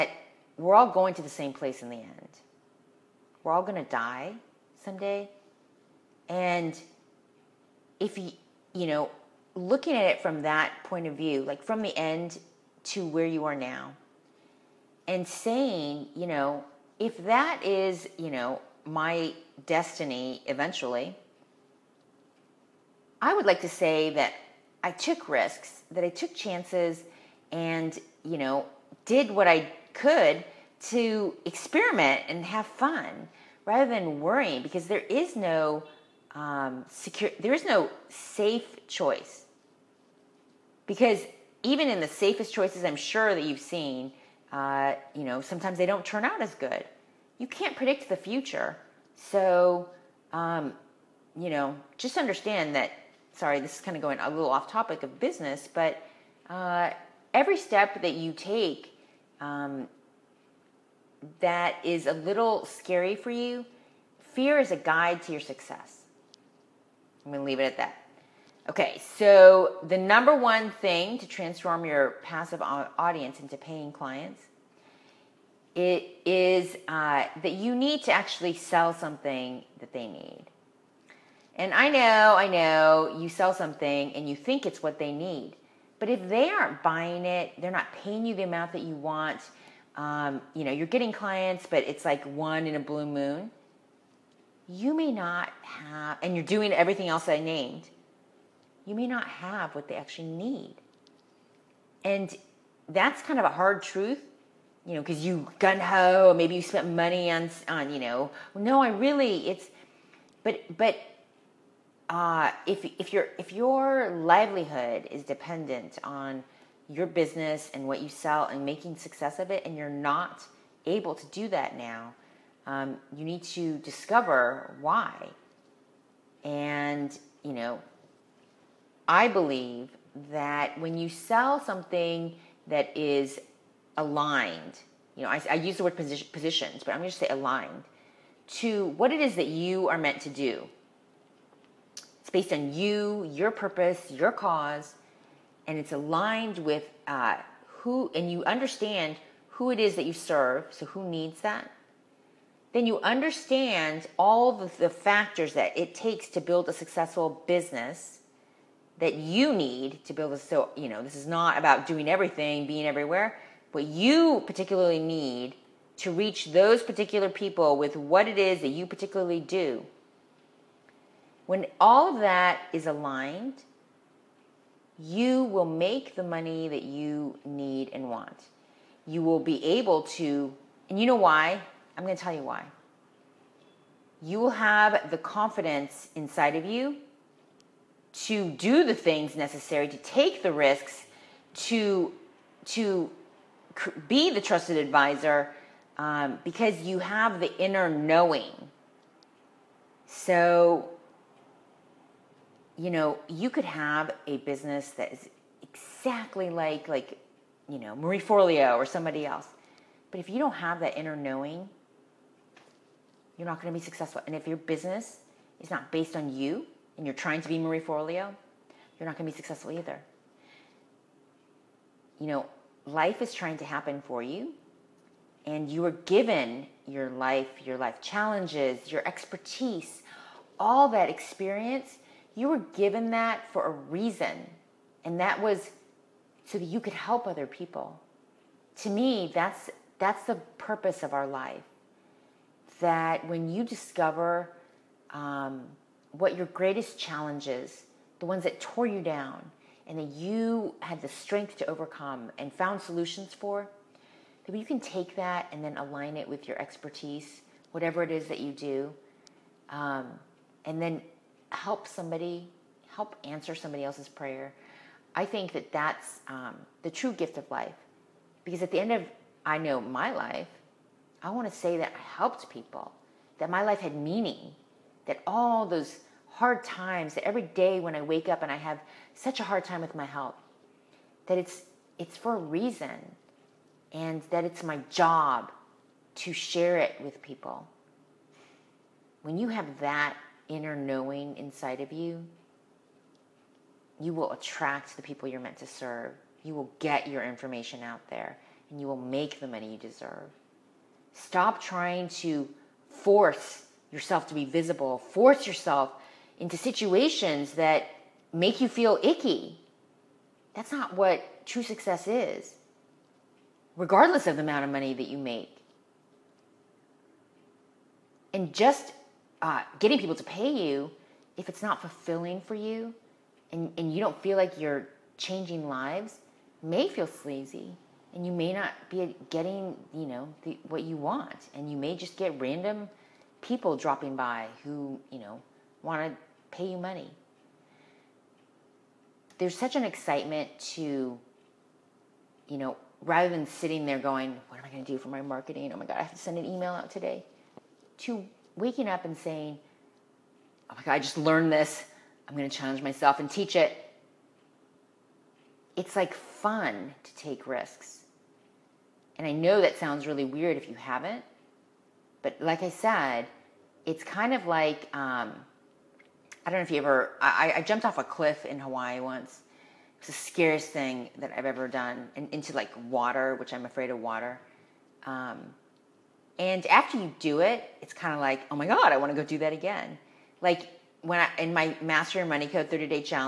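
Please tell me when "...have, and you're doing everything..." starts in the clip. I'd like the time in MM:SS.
01:35.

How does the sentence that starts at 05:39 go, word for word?
There's such an excitement to, you know, rather than sitting there going, what am I going to do for my marketing?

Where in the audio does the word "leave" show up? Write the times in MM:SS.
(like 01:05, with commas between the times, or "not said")
01:07.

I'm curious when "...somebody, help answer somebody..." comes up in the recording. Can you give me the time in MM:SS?
04:21.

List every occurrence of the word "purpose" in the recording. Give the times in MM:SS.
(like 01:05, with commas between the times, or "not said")
02:23, 04:00.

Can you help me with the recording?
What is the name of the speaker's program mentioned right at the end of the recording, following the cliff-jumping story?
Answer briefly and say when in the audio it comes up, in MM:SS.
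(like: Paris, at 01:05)
Master Your Money Code, at 06:21.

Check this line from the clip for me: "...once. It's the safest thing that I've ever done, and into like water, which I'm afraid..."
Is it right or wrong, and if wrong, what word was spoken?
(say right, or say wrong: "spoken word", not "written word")
wrong: "scariest", not "safest".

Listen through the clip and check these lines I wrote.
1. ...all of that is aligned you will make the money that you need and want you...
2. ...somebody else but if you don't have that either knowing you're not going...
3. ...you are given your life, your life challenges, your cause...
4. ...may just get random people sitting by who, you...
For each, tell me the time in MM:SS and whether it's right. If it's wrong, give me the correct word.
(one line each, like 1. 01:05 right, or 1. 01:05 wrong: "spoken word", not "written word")
1. 02:51 right
2. 03:28 wrong: "inner", not "either"
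3. 03:45 wrong: "expertise", not "cause"
4. 05:31 wrong: "dropping", not "sitting".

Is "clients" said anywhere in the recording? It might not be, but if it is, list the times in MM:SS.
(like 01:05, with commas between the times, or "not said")
01:13, 01:31.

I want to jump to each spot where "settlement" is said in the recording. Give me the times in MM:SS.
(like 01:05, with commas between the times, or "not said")
not said.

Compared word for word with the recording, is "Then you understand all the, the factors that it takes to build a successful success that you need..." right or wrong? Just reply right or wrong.
wrong.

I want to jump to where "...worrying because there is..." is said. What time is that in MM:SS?
00:34.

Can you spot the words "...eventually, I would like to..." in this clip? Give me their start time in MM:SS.
00:20.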